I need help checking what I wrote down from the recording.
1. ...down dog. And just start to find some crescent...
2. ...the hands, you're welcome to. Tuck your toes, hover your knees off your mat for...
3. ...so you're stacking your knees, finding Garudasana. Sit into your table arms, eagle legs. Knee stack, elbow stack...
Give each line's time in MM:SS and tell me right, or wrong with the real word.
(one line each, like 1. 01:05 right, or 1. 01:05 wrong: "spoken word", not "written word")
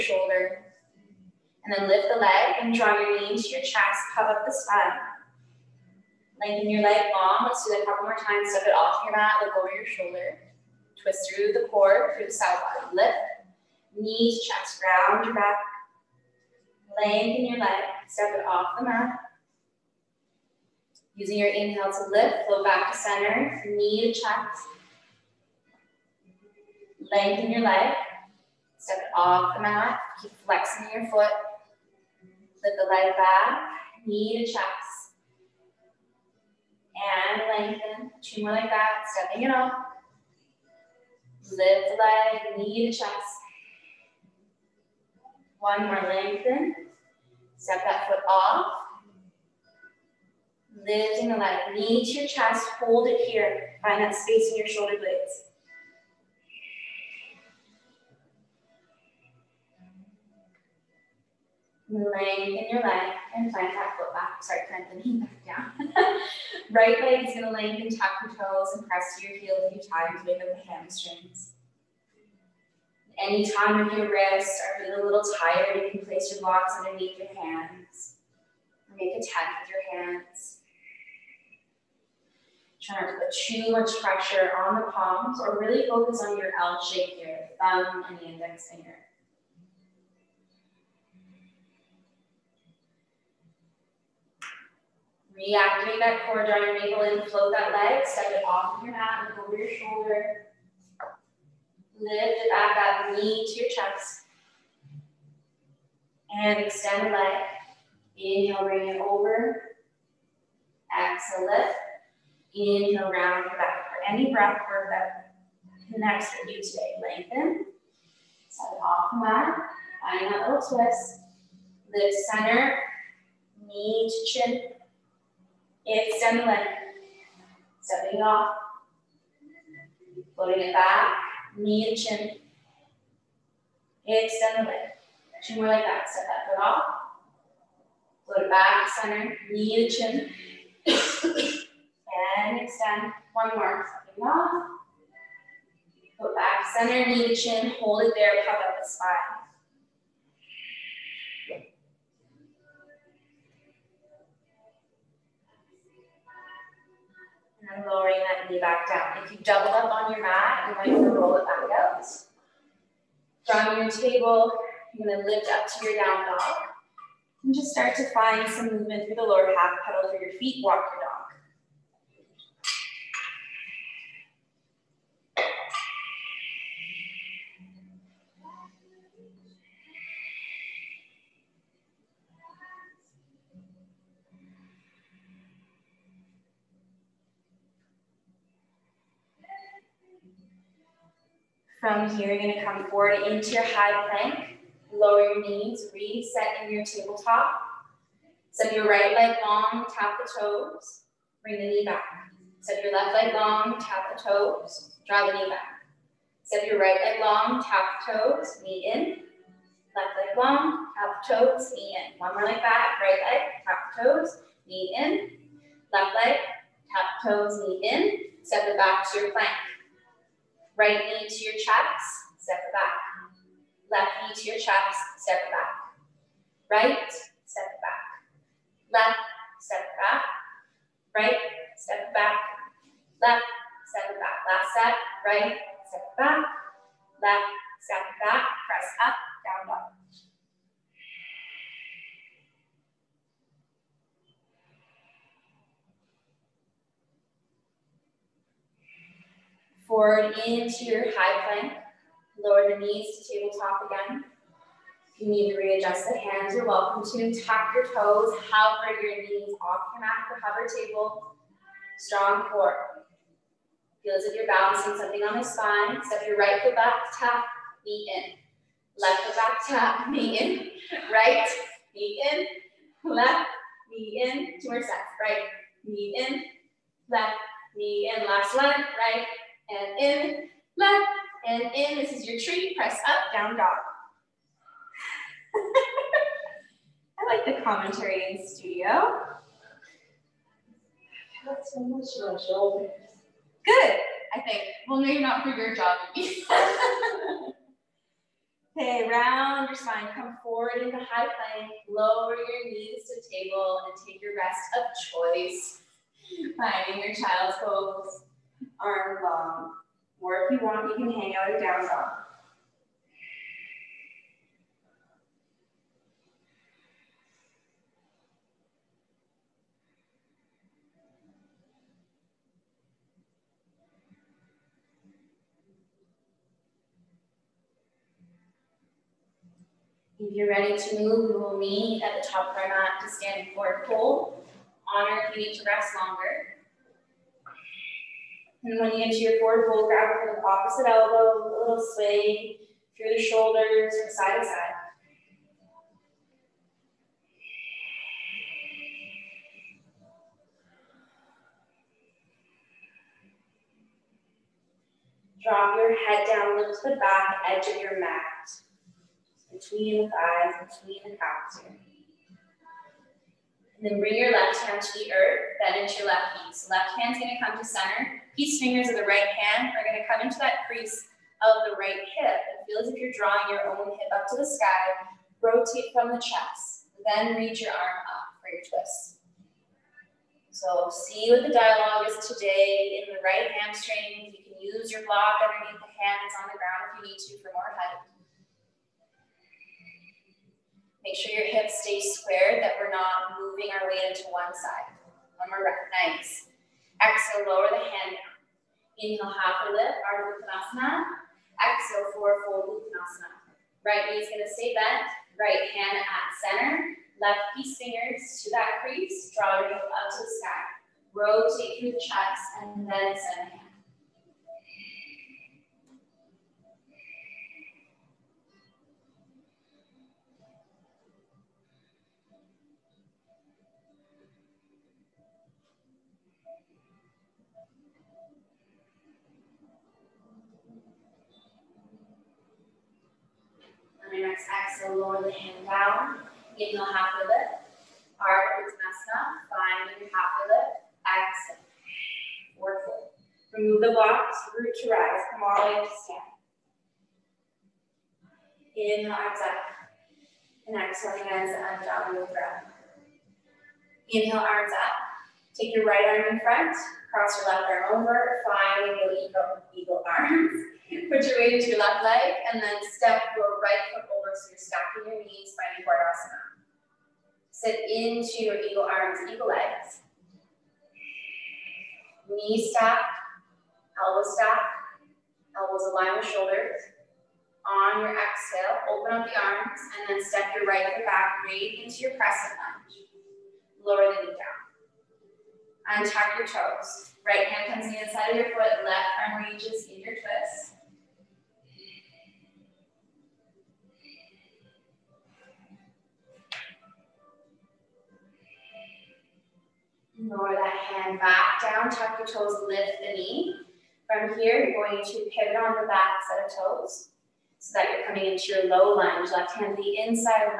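1. 02:46 wrong: "movement", not "crescent"
2. 04:16 right
3. 07:44 wrong: "eagle", not "table".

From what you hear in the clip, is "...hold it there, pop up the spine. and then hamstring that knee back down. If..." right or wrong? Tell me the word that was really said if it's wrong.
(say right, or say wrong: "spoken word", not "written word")
wrong: "lowering", not "hamstring".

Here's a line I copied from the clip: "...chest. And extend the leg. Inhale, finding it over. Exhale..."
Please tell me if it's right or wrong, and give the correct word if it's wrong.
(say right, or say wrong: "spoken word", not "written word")
wrong: "bring", not "finding".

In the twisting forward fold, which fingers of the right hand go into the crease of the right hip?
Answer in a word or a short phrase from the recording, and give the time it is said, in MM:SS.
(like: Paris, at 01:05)
peace fingers, at 06:08.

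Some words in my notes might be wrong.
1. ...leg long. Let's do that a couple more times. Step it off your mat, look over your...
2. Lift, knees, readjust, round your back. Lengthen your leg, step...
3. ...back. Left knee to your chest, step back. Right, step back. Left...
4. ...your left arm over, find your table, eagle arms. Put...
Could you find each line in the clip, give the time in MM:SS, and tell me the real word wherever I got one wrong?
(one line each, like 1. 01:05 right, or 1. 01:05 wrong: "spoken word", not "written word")
1. 00:06 right
2. 00:12 wrong: "chest", not "readjust"
3. 03:42 right
4. 07:37 wrong: "eagle", not "table".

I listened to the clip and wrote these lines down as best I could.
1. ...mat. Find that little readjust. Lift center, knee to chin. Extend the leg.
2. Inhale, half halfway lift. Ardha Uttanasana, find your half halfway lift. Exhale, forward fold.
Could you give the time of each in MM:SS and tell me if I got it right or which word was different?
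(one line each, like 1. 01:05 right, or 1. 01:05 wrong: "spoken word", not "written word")
1. 01:59 wrong: "twist", not "readjust"
2. 07:16 right.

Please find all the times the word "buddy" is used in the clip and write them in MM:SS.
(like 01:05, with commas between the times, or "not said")
not said.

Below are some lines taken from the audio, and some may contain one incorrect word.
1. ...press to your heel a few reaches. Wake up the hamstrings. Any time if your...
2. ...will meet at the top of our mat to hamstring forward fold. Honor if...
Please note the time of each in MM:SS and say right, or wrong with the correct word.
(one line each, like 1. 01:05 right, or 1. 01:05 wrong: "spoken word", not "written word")
1. 01:08 wrong: "times", not "reaches"
2. 05:31 wrong: "standing", not "hamstring".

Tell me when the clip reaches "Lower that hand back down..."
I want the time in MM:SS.
08:20.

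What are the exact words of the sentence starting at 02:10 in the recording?
Floating it back, knee to chin.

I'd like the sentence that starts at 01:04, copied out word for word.
Sorry, plant the knee back down.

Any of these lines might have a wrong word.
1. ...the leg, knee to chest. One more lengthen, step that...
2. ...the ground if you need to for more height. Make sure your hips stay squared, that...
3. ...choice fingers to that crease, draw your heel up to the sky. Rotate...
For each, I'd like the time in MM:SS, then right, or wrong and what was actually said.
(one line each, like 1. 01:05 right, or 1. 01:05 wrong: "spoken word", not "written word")
1. 00:41 right
2. 06:26 right
3. 06:47 wrong: "piece", not "choice".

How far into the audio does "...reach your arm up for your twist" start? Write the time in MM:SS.
06:17.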